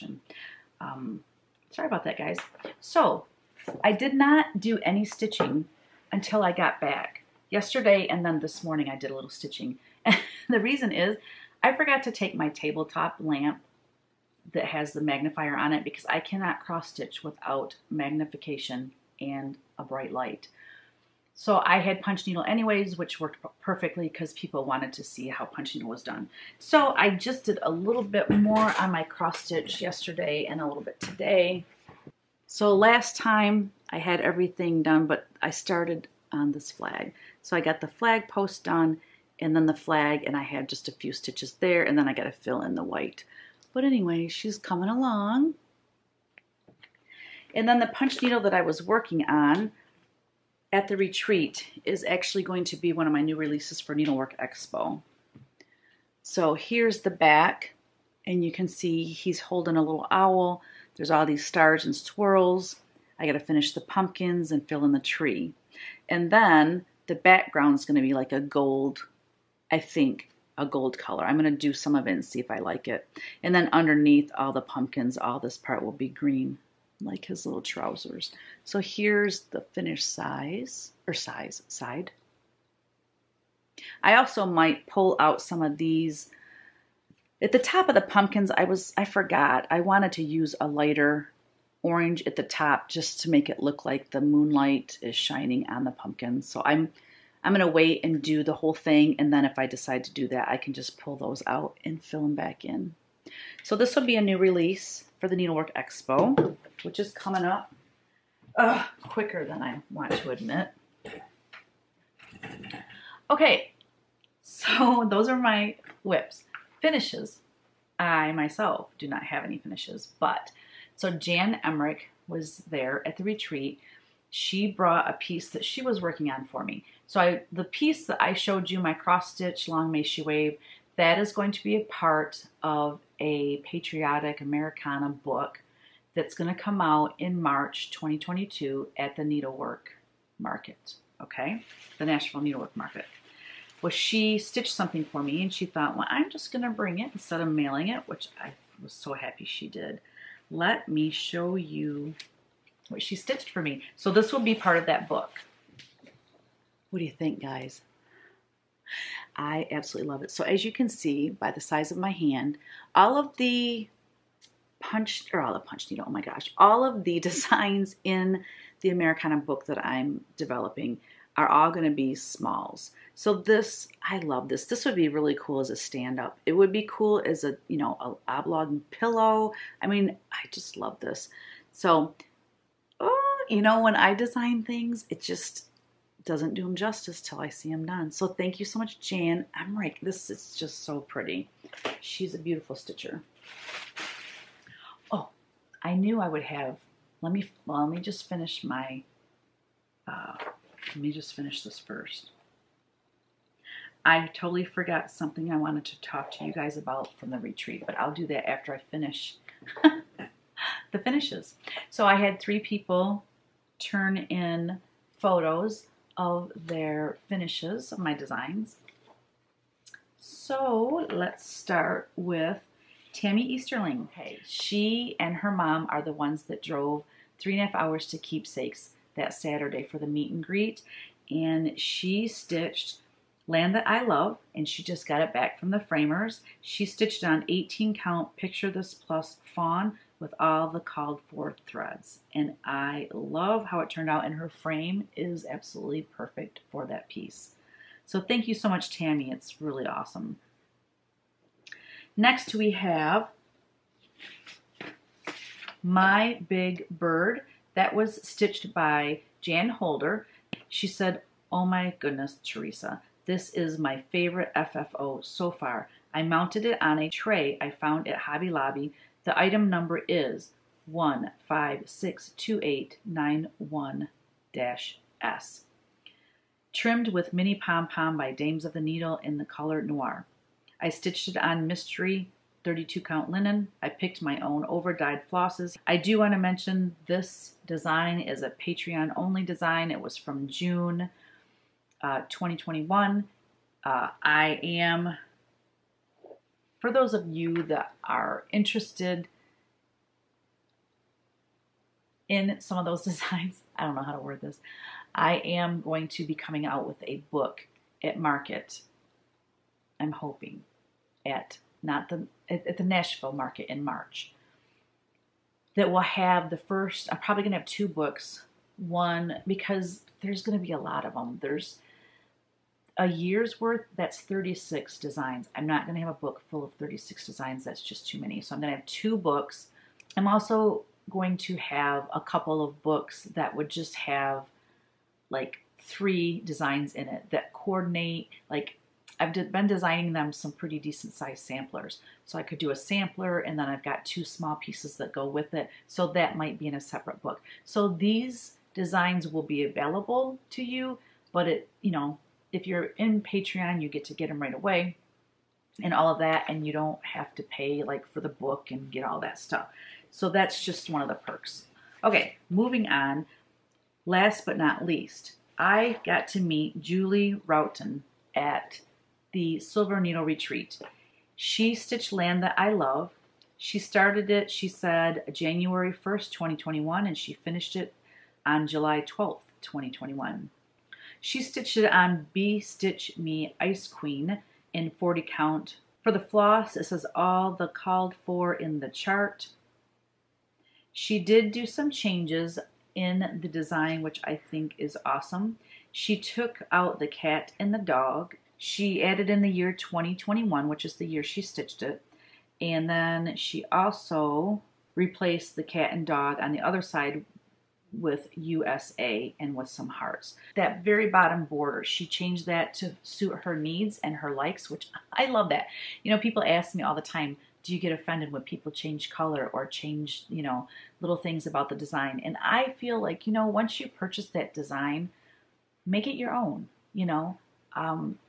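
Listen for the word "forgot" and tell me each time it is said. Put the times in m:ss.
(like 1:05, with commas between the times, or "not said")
0:11, 1:29, 3:24.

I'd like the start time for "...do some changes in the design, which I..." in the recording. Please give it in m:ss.
6:31.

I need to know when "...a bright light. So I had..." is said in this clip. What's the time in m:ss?
0:19.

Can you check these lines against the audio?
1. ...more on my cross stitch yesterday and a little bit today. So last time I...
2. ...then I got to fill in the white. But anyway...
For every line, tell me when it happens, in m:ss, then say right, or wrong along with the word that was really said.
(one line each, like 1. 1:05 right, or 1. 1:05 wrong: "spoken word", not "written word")
1. 0:28 right
2. 0:41 right.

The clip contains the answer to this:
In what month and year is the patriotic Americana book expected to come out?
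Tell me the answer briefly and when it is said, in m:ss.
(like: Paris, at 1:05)
March 2022, at 2:17.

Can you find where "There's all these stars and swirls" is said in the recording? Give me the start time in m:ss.
1:00.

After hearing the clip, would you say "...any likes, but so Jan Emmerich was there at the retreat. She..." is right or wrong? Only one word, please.
wrong.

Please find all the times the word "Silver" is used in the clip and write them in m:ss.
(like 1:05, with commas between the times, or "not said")
6:09.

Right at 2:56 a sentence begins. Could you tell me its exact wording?
It would be cool as a, you know, a oblong pillow.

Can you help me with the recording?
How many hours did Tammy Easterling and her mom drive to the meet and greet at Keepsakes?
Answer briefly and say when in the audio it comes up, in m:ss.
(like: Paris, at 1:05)
3 and a half hours, at 3:47.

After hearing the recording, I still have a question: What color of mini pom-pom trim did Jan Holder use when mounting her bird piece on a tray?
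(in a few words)
noir.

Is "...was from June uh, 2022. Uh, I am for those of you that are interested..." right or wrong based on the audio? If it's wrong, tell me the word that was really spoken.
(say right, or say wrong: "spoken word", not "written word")
wrong: "2021", not "2022".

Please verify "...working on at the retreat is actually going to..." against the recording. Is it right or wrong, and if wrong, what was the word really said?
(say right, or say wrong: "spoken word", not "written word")
right.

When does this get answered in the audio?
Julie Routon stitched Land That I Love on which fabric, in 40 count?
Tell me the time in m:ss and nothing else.
6:22.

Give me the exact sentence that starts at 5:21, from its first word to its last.
There's a year's worth, that's 36 designs.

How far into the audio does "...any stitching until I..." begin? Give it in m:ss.
0:04.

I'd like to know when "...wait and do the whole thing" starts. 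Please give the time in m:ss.
1:37.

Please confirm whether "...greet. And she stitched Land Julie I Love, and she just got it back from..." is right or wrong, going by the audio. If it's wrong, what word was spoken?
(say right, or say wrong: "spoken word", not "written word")
wrong: "That", not "Julie".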